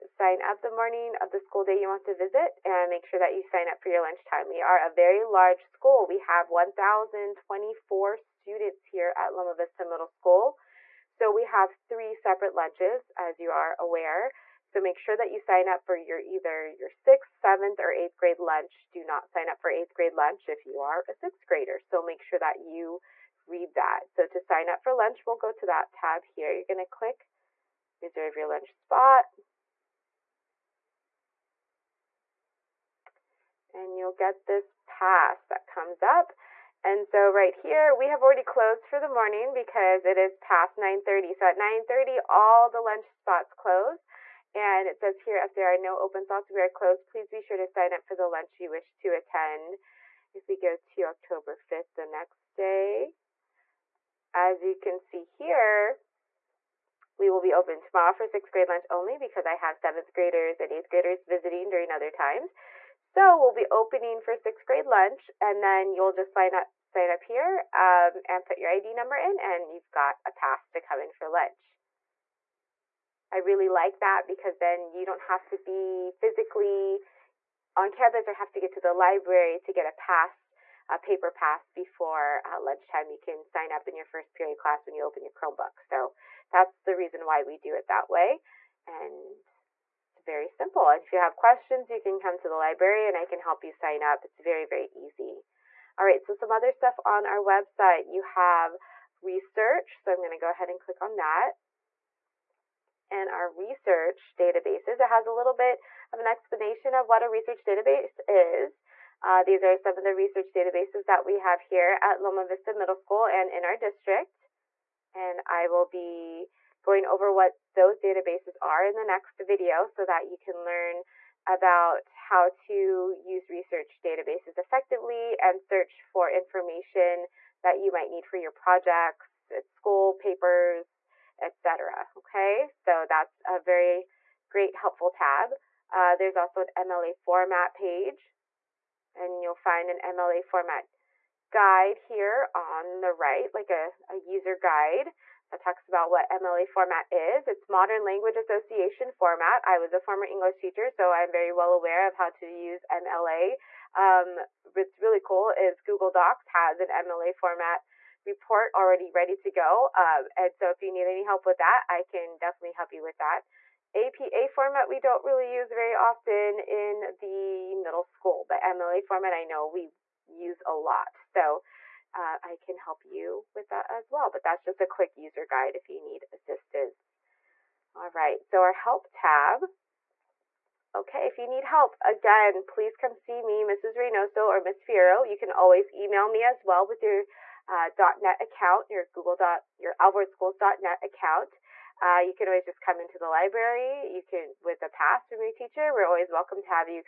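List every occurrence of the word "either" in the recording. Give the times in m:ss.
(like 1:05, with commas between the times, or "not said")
0:16.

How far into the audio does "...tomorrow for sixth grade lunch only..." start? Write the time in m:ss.
0:57.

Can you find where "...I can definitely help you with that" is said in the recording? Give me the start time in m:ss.
2:41.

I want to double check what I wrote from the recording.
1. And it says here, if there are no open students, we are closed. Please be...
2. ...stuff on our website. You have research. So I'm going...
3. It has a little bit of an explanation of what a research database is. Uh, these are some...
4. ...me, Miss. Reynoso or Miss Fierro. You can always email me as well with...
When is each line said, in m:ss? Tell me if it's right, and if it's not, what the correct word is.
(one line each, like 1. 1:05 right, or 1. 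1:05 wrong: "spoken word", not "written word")
1. 0:44 wrong: "slots", not "students"
2. 1:36 right
3. 1:45 right
4. 3:03 wrong: "Mrs", not "Miss".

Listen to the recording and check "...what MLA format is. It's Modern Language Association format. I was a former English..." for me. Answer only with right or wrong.
right.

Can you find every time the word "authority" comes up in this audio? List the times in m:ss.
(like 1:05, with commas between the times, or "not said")
not said.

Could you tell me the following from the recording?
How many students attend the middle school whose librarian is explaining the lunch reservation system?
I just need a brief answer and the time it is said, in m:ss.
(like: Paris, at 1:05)
1,024, at 0:06.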